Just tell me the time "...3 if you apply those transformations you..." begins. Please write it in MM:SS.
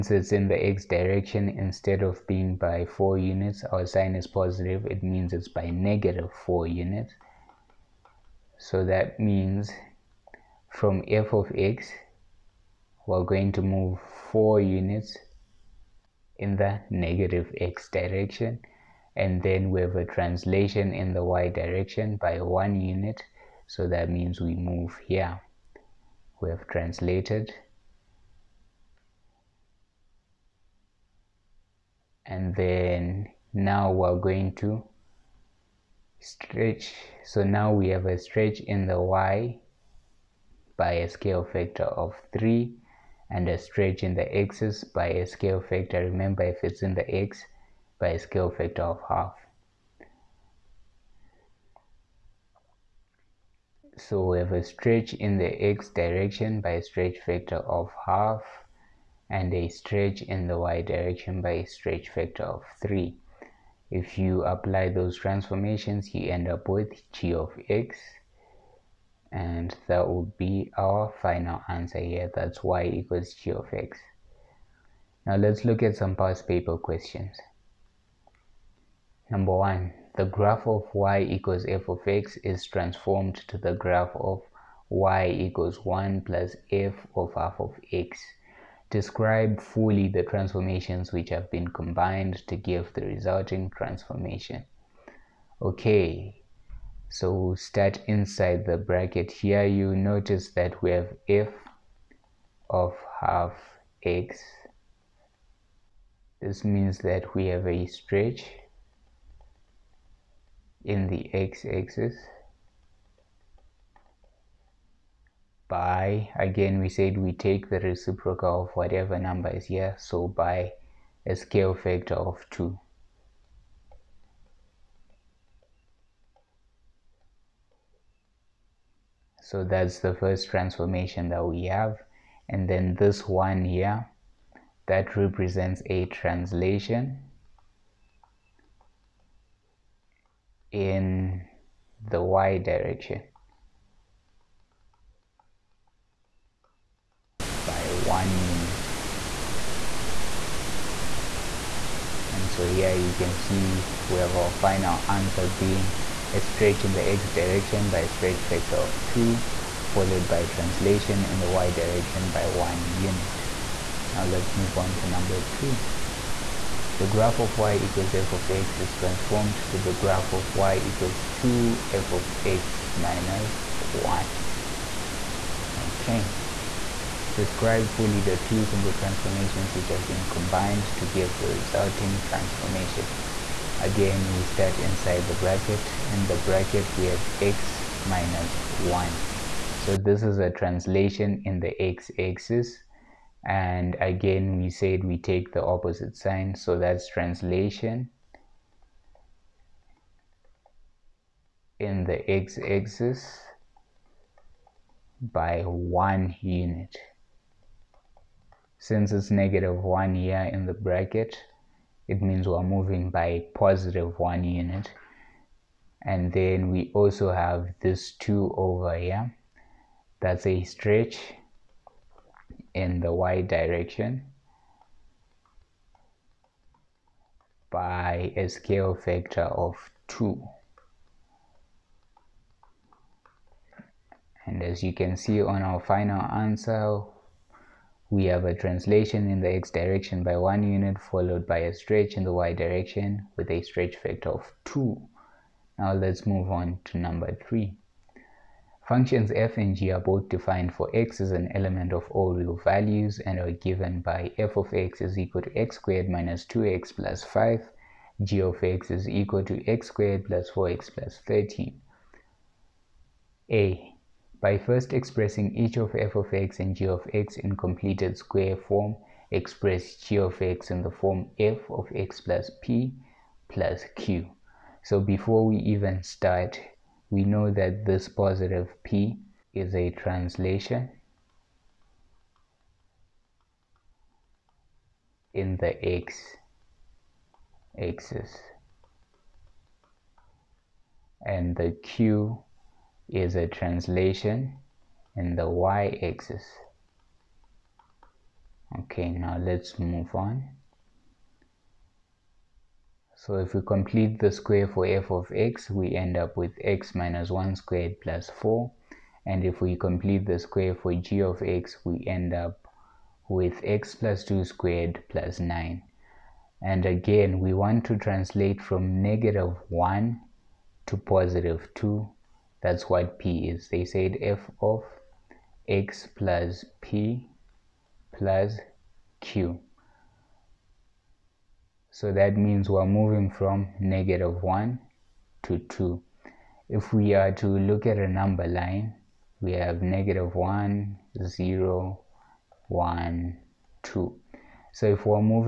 01:02.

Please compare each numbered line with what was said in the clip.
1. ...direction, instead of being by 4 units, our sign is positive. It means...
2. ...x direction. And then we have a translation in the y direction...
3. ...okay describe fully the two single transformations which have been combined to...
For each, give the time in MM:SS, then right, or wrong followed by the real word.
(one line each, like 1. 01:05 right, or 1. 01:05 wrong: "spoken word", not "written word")
1. 00:00 right
2. 00:17 right
3. 02:55 right.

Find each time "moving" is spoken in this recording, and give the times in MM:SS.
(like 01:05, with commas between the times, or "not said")
03:32, 05:32.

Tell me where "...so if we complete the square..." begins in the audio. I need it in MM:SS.
05:03.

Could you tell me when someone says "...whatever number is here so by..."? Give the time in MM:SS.
01:58.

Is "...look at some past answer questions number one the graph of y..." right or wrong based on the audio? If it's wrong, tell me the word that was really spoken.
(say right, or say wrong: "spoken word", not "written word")
wrong: "paper", not "answer".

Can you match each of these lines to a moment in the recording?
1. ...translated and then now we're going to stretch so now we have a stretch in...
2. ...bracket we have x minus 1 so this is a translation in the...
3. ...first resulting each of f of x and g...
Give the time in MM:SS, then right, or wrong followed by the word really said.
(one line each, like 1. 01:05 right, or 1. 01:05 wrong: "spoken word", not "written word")
1. 00:26 right
2. 03:06 right
3. 04:24 wrong: "expressing", not "resulting".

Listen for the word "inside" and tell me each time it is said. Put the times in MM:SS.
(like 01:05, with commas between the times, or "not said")
01:38, 03:04.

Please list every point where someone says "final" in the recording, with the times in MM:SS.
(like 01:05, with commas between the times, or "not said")
01:11, 02:34, 03:55.